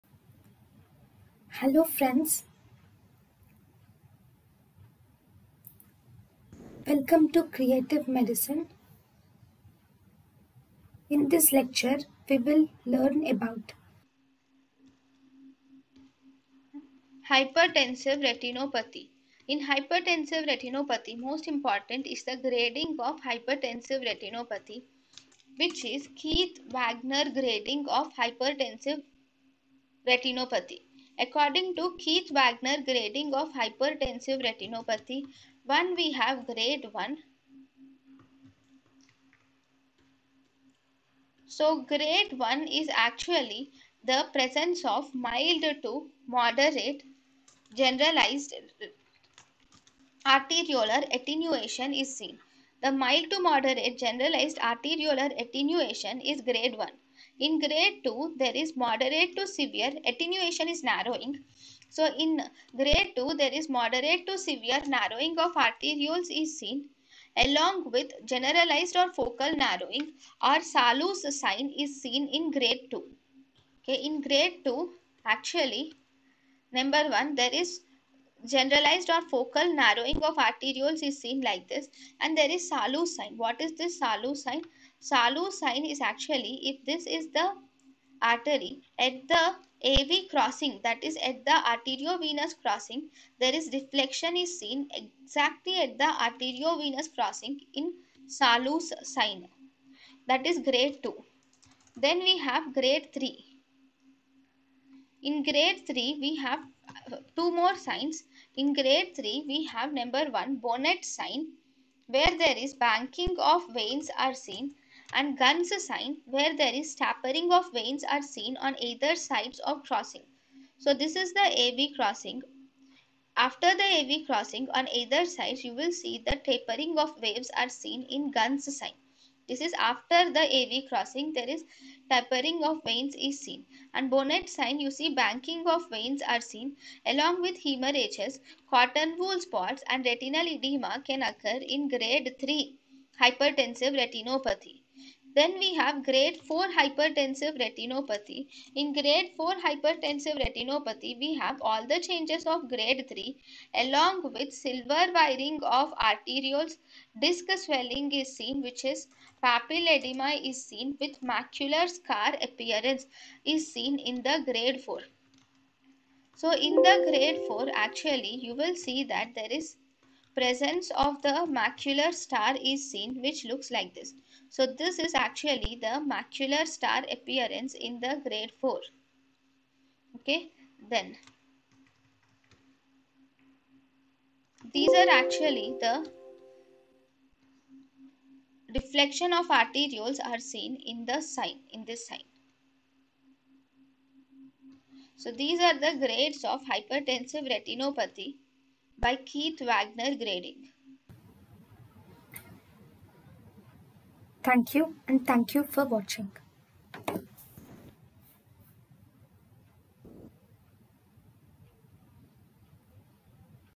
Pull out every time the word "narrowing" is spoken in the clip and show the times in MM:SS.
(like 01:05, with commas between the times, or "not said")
01:00, 01:04, 01:09, 01:19.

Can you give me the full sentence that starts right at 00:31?
According to Keith Wagner grading of hypertensive retinopathy, 1 we have grade 1.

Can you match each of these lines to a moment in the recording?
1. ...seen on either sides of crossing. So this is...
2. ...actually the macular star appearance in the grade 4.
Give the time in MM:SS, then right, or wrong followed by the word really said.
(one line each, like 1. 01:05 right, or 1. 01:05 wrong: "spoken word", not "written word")
1. 01:58 right
2. 02:55 right.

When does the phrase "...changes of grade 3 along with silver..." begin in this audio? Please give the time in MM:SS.
02:32.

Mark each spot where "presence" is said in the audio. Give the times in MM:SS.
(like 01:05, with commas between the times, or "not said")
00:44, 02:50.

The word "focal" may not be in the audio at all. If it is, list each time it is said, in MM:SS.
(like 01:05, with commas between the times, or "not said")
01:09, 01:19.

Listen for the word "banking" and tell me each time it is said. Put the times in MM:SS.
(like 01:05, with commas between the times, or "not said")
01:52, 02:15.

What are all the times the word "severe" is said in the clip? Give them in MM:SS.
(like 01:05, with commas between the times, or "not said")
00:59, 01:04.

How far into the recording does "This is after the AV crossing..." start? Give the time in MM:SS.
02:09.